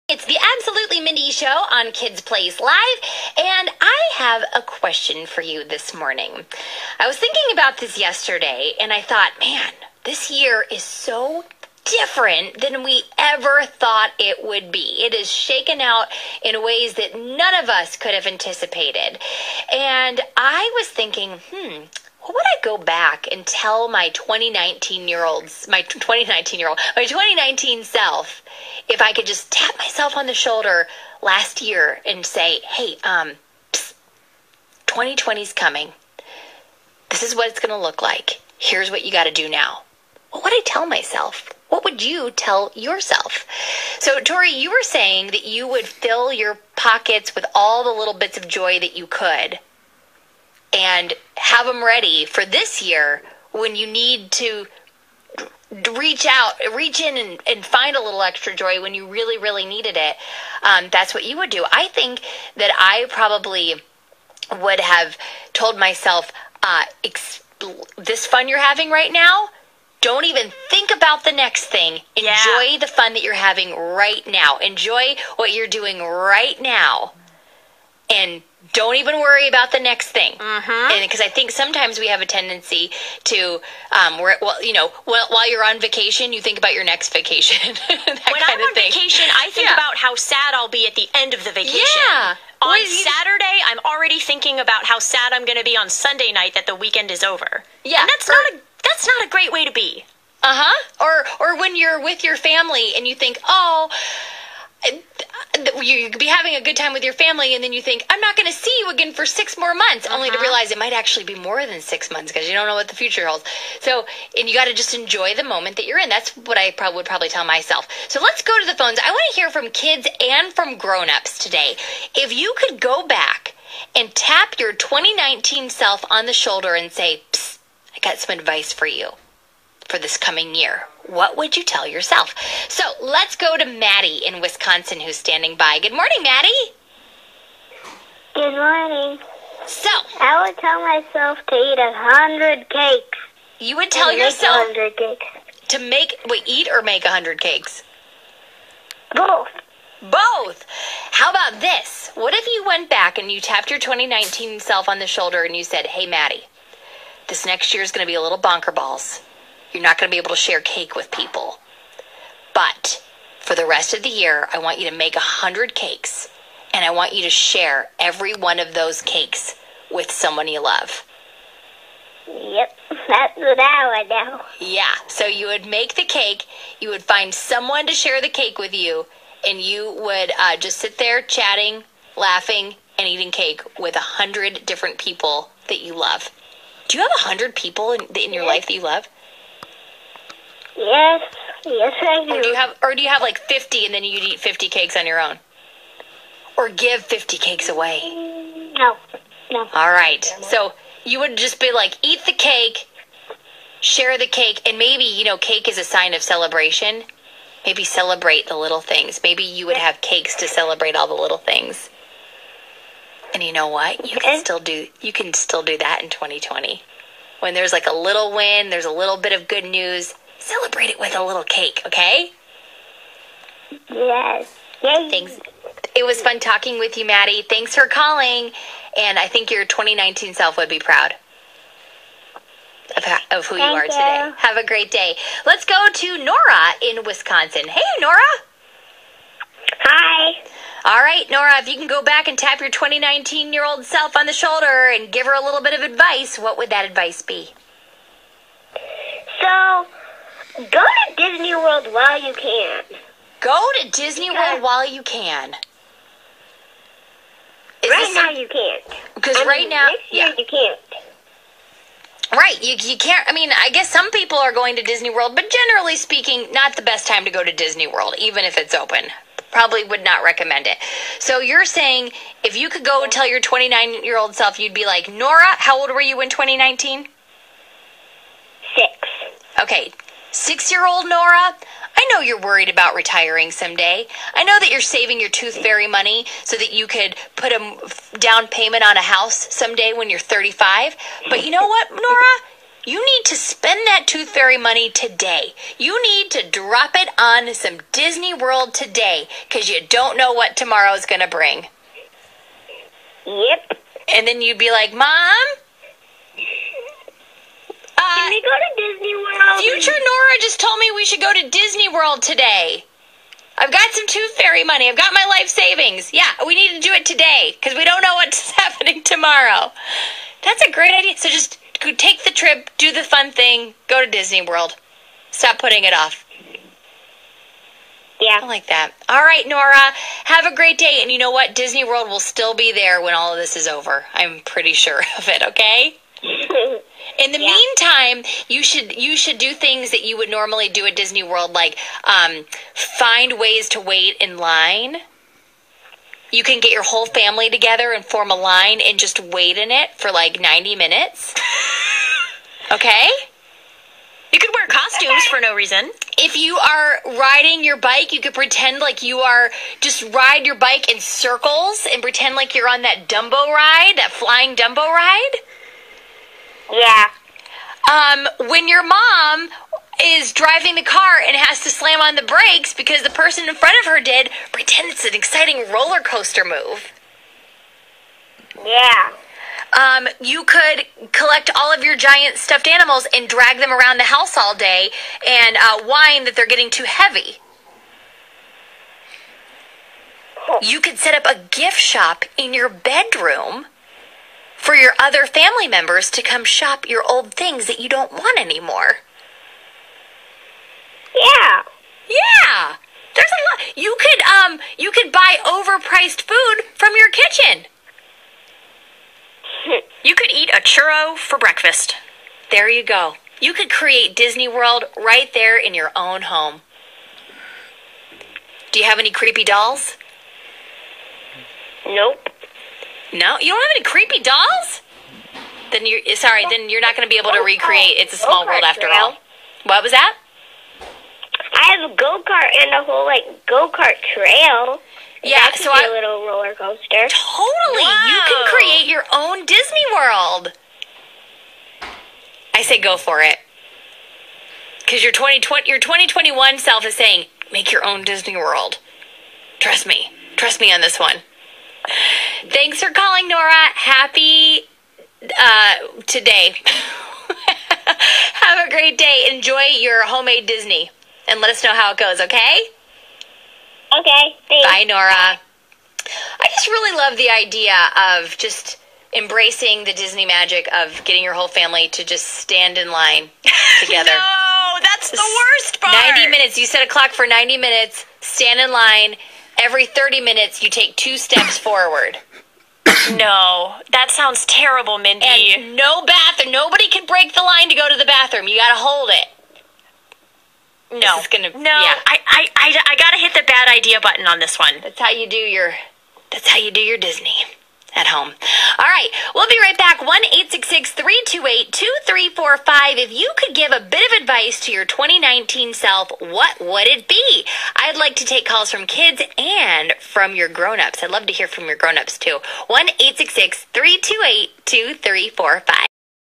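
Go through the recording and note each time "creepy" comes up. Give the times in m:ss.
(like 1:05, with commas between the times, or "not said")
6:59, 7:03.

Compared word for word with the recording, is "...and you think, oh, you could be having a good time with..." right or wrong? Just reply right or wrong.
right.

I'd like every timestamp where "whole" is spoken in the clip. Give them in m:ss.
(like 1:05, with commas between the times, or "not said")
5:46, 7:12, 7:51.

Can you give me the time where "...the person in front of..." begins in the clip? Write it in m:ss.
6:13.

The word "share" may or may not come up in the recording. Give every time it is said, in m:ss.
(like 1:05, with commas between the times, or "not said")
2:40, 2:47, 2:57, 3:23.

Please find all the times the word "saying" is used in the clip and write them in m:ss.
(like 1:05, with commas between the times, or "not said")
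0:44, 4:31, 7:26.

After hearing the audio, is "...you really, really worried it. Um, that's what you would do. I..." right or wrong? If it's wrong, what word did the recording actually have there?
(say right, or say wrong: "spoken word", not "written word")
wrong: "needed", not "worried".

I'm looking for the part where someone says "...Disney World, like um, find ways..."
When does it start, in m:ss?
5:40.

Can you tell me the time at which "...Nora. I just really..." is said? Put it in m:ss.
7:44.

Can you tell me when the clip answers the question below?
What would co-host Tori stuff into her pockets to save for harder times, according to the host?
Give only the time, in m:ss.
0:47.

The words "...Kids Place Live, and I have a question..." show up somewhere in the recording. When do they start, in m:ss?
0:01.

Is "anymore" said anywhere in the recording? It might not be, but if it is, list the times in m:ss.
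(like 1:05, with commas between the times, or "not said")
6:38.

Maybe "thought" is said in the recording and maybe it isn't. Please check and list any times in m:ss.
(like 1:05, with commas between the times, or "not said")
0:09, 0:13.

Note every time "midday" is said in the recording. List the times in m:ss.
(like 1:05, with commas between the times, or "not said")
not said.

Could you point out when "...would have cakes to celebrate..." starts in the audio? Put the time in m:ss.
3:29.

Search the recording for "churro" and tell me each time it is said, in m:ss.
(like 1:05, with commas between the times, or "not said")
6:50.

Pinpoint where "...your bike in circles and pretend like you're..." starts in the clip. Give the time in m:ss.
6:00.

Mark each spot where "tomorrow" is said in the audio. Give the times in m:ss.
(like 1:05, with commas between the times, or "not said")
5:00, 5:19.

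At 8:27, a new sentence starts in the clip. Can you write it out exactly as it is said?
I'd like to take calls from kids and from your grown ups.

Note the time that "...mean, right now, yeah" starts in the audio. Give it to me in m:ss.
4:19.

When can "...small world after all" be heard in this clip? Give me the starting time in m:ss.
7:08.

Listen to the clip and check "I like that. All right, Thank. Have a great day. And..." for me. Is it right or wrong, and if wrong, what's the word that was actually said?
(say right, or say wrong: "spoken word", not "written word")
wrong: "Nora", not "Thank".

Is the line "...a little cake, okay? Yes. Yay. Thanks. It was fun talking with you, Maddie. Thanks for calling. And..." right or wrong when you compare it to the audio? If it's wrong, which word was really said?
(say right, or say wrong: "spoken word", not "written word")
right.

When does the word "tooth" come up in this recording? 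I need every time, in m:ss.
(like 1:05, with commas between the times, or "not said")
4:45, 4:54, 5:14.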